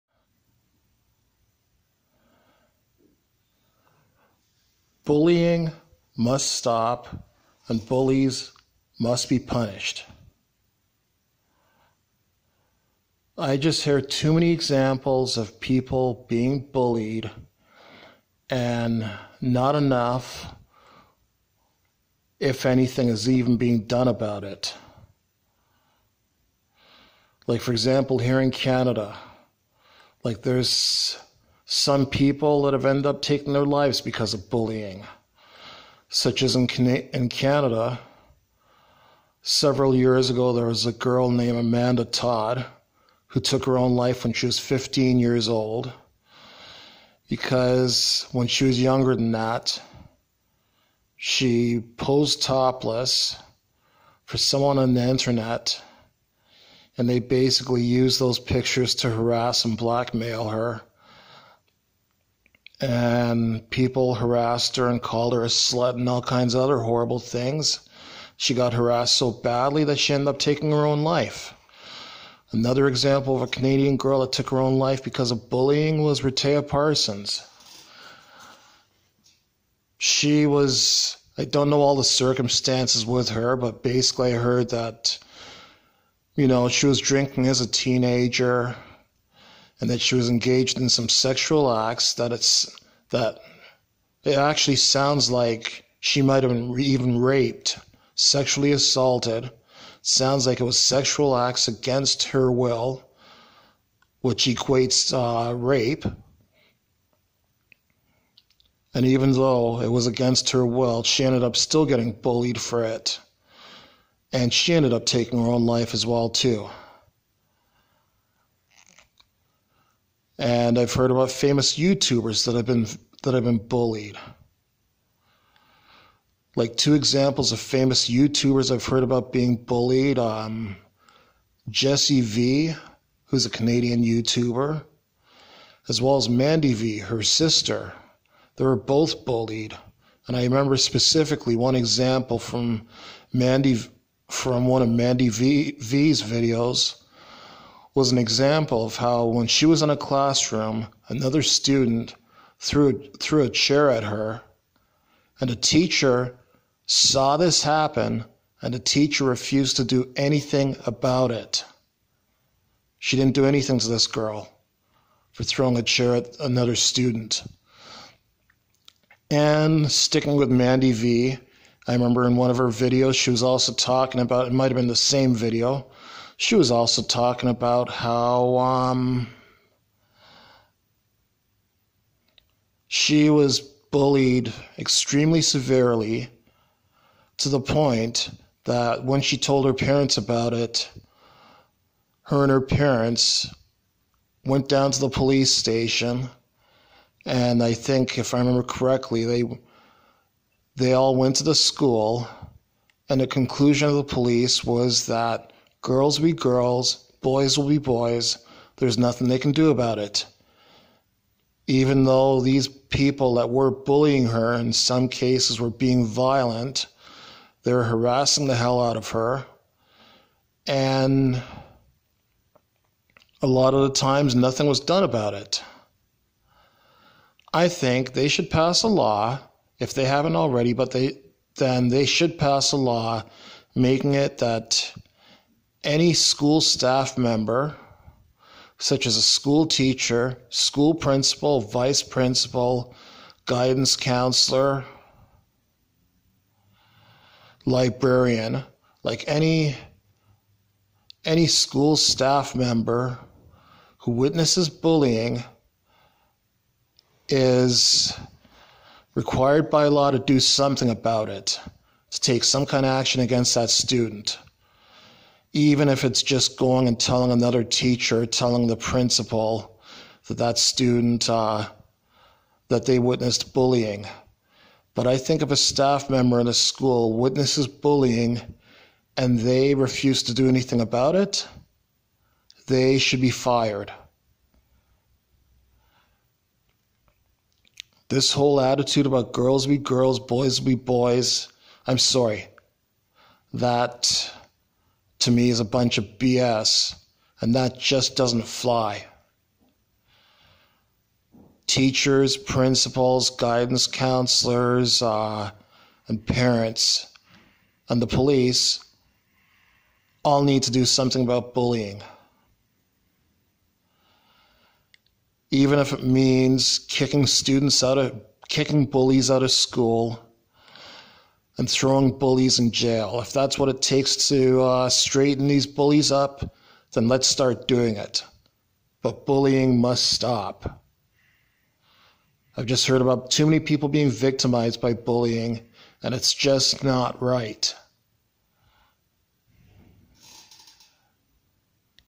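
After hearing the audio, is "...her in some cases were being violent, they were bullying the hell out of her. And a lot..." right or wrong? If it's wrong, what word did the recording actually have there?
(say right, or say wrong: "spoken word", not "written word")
wrong: "harassing", not "bullying".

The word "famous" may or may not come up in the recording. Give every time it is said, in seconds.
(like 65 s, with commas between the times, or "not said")
121 s, 127 s.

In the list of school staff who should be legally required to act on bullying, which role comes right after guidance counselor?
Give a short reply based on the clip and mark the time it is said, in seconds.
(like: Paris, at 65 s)
librarian, at 247 s.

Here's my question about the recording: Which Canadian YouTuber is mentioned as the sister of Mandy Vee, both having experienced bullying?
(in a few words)
Jessii Vee.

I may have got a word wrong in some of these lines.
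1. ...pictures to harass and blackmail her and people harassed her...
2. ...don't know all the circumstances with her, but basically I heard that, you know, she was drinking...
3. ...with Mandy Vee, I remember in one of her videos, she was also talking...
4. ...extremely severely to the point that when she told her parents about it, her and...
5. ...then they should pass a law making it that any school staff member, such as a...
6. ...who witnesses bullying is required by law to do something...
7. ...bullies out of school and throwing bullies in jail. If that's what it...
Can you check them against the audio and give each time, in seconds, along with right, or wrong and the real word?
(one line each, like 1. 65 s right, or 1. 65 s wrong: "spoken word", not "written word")
1. 58 s right
2. 81 s right
3. 170 s right
4. 184 s right
5. 231 s right
6. 253 s right
7. 318 s right.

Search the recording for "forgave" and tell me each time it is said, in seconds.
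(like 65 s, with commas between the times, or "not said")
not said.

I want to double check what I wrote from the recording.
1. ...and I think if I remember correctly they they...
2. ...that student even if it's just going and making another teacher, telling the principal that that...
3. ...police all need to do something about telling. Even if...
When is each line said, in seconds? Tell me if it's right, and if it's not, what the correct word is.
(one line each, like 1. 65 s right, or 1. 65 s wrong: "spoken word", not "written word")
1. 197 s right
2. 263 s wrong: "telling", not "making"
3. 308 s wrong: "bullying", not "telling".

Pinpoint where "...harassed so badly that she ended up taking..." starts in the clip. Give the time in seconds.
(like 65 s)
68 s.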